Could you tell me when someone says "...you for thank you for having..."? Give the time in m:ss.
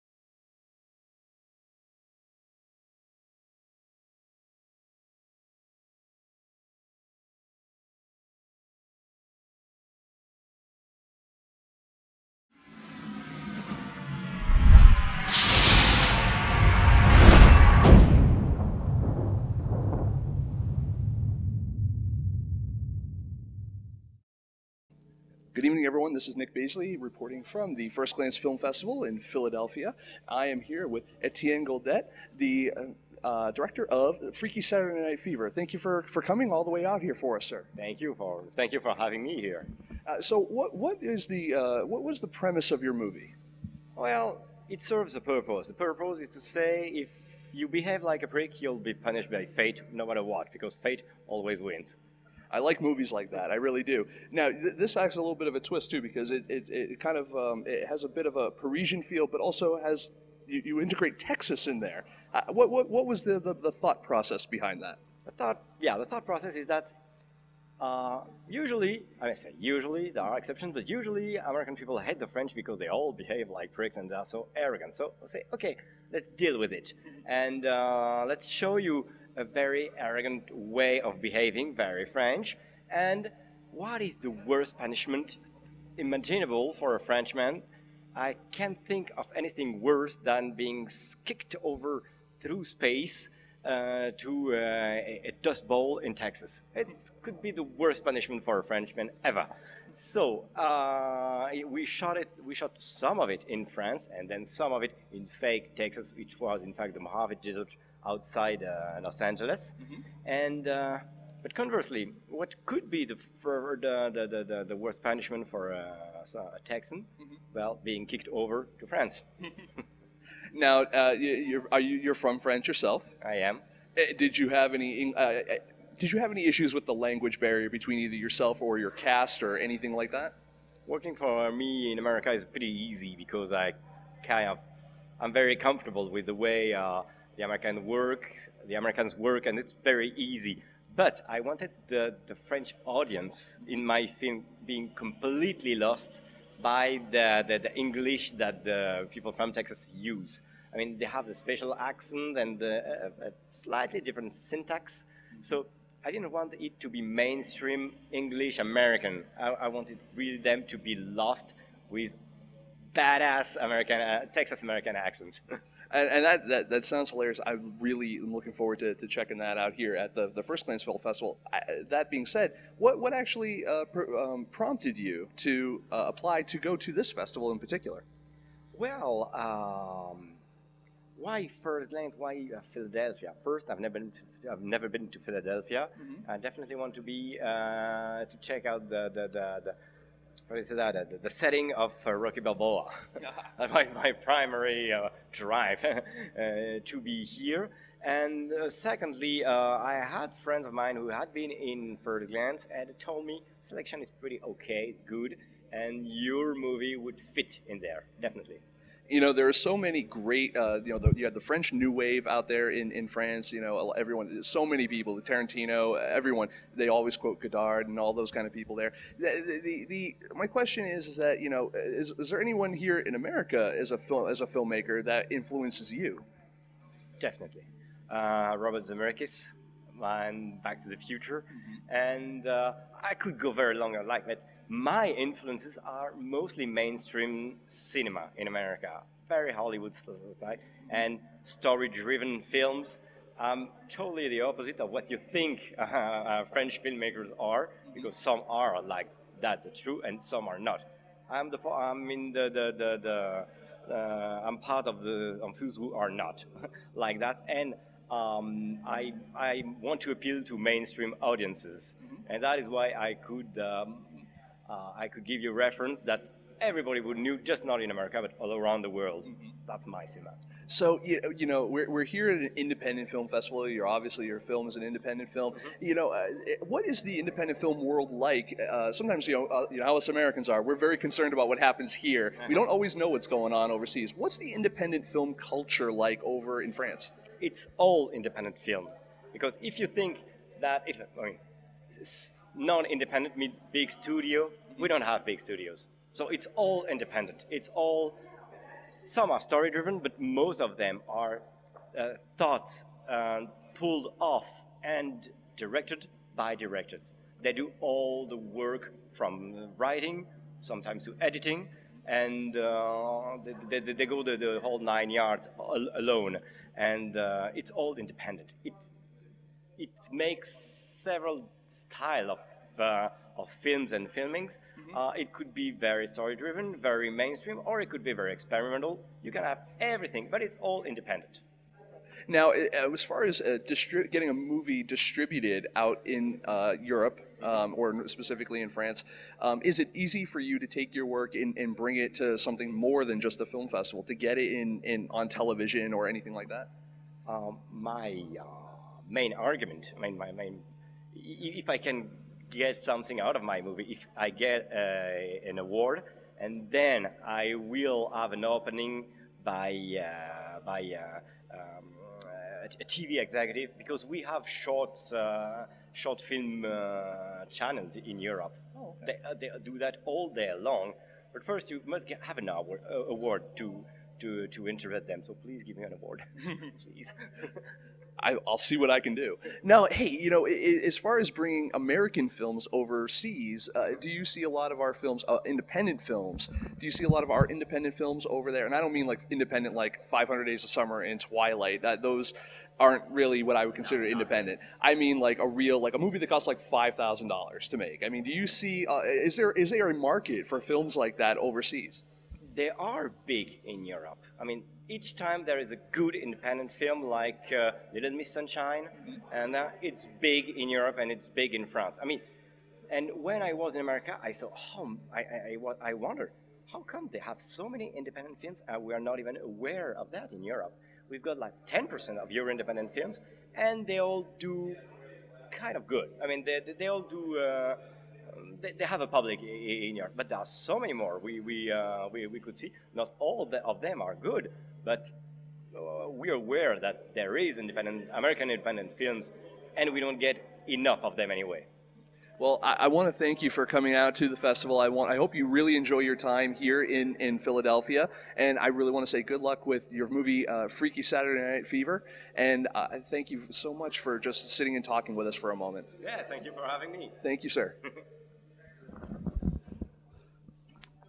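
0:38.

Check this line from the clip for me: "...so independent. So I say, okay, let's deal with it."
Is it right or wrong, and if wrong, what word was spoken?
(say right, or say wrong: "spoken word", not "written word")
wrong: "arrogant", not "independent".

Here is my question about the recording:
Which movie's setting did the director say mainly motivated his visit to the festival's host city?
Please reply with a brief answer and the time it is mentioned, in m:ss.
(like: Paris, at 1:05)
Rocky Balboa, at 3:12.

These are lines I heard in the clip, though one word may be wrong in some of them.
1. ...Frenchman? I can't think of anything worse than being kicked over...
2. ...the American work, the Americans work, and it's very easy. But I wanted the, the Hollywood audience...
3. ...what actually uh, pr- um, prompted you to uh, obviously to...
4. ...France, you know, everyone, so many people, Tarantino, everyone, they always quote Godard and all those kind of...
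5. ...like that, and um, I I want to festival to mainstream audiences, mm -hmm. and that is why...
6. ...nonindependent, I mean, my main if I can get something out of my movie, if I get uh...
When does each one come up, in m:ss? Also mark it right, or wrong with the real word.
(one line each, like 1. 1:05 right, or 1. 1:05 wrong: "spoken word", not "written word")
1. 1:26 right
2. 2:17 wrong: "French", not "Hollywood"
3. 2:52 wrong: "apply", not "obviously"
4. 3:33 right
5. 4:16 wrong: "appeal", not "festival"
6. 5:49 wrong: "argument", not "nonindependent".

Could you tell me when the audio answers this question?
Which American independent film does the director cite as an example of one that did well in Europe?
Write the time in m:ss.
6:47.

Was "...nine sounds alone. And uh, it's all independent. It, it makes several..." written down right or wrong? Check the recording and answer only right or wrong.
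wrong.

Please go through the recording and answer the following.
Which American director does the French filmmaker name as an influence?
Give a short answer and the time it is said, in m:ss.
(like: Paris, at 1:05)
Robert Zemeckis, at 3:48.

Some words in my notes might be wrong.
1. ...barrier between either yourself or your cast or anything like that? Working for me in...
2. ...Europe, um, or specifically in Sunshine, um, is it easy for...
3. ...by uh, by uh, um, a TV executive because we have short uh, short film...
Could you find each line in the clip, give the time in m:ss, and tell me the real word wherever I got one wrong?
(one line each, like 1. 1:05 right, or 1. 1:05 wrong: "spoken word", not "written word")
1. 2:07 right
2. 5:36 wrong: "France", not "Sunshine"
3. 5:59 right.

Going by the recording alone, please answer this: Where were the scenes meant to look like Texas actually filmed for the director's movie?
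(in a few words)
Mojave Desert.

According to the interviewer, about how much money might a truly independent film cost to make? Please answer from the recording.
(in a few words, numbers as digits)
$5,000.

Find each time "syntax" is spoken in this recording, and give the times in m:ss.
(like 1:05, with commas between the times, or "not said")
2:34.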